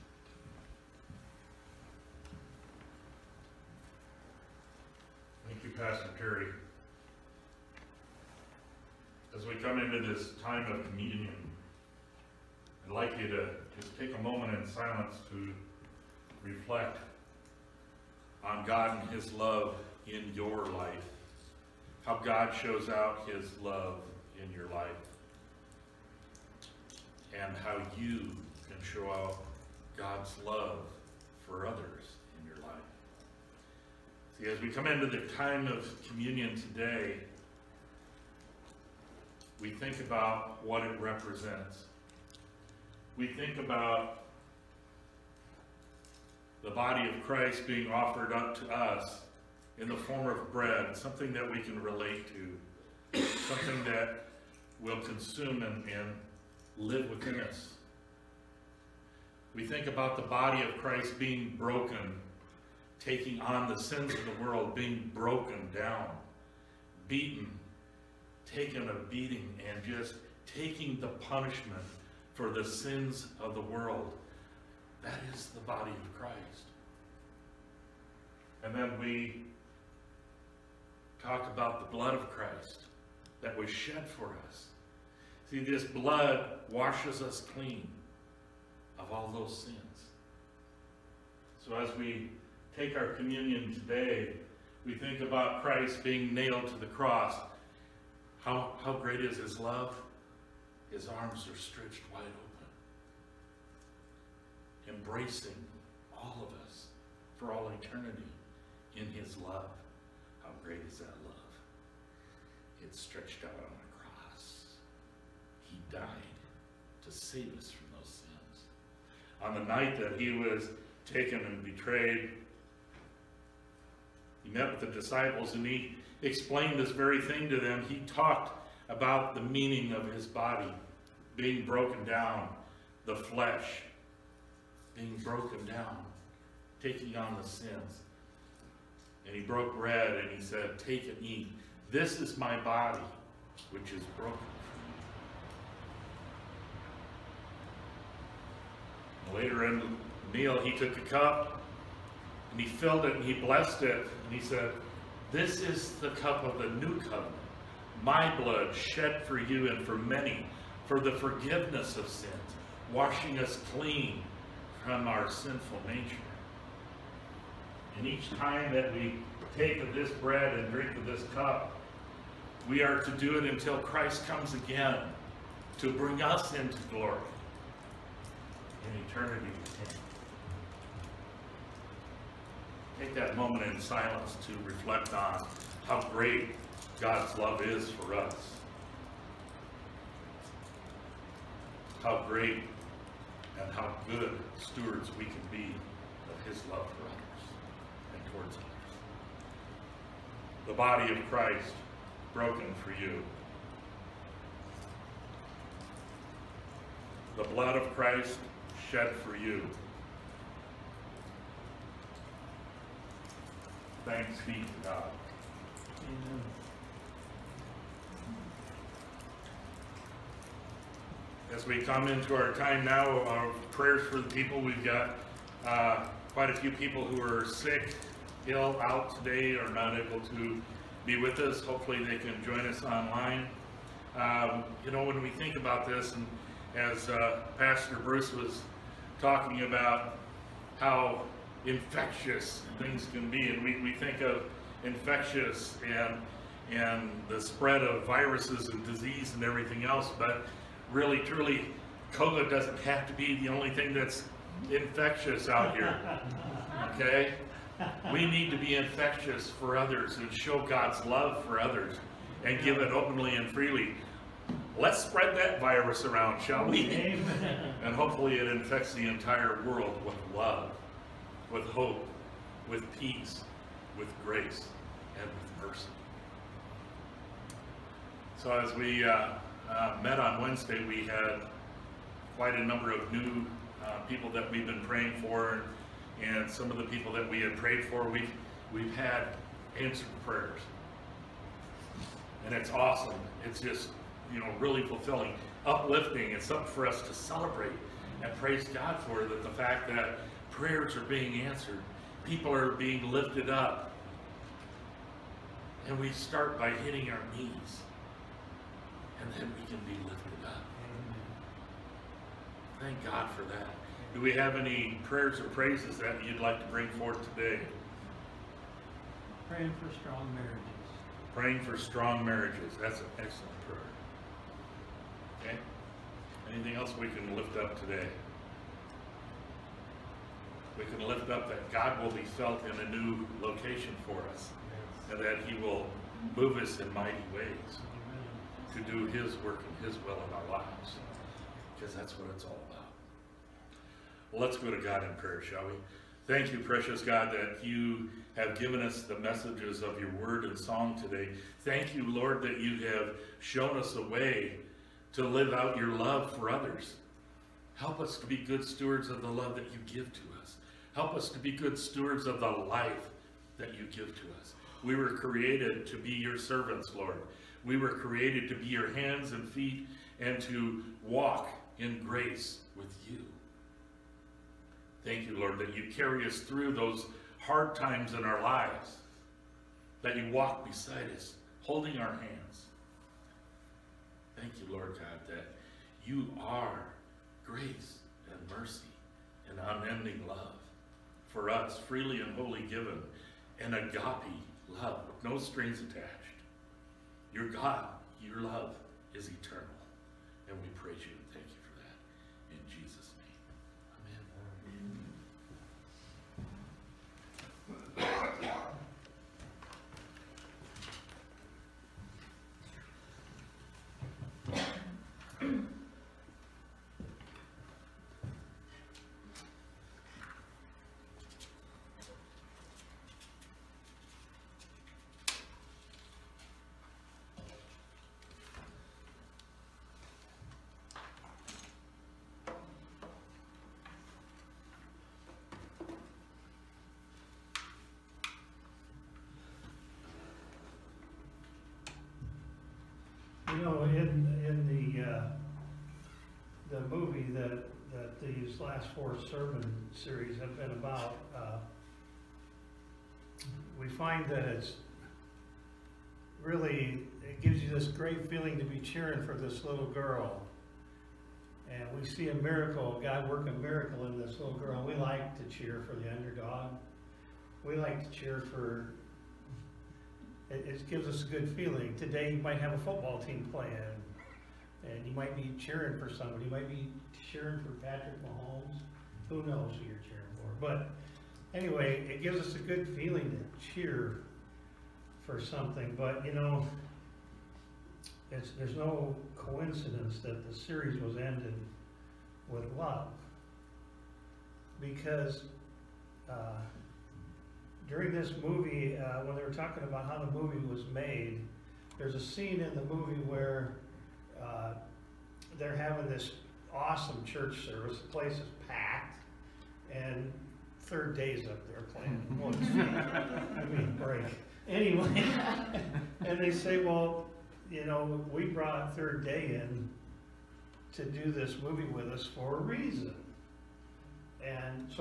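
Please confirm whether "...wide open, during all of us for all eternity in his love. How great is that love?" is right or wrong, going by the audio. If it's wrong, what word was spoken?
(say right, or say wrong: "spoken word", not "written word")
wrong: "embracing", not "during".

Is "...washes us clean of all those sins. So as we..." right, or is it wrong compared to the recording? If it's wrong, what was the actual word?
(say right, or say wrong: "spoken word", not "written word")
right.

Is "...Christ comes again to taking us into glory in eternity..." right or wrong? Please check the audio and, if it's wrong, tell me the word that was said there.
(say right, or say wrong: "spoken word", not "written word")
wrong: "bring", not "taking".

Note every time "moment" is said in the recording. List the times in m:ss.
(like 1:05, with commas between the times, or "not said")
0:14, 3:03.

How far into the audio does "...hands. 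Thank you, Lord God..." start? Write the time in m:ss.
6:22.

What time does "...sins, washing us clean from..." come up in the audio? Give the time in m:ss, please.
2:42.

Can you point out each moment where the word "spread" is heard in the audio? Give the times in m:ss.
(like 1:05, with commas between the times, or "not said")
4:07, 4:25.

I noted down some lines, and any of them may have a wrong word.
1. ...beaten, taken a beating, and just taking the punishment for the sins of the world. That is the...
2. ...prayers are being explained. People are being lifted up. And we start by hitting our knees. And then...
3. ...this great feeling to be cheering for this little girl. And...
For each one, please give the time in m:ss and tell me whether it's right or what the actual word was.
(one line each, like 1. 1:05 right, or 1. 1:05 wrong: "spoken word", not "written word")
1. 1:07 right
2. 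5:00 wrong: "answered", not "explained"
3. 7:37 right.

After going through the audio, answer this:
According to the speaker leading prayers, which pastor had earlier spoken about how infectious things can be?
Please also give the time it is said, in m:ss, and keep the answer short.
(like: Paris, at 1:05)
Pastor Bruce, at 3:57.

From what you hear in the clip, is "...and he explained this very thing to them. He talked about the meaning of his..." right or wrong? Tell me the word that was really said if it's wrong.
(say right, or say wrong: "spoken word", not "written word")
right.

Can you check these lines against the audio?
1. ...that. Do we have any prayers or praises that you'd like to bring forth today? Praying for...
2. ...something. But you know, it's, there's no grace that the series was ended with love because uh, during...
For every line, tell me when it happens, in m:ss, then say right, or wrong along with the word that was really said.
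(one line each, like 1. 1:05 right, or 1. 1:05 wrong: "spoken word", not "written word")
1. 5:13 right
2. 8:05 wrong: "coincidence", not "grace".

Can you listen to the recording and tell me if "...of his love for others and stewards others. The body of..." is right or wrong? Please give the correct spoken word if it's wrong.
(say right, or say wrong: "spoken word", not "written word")
wrong: "towards", not "stewards".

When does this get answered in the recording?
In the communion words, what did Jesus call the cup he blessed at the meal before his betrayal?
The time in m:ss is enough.
2:35.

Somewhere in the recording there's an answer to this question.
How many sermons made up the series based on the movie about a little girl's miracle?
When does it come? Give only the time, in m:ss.
7:28.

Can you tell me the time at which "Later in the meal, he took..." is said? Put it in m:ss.
2:29.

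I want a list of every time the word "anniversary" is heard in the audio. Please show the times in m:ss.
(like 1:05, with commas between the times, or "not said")
not said.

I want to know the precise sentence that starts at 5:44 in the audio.
Well, let's go to God in prayer, shall we?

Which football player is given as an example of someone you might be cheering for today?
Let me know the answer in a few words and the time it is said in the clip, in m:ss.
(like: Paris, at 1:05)
Patrick Mahomes, at 7:57.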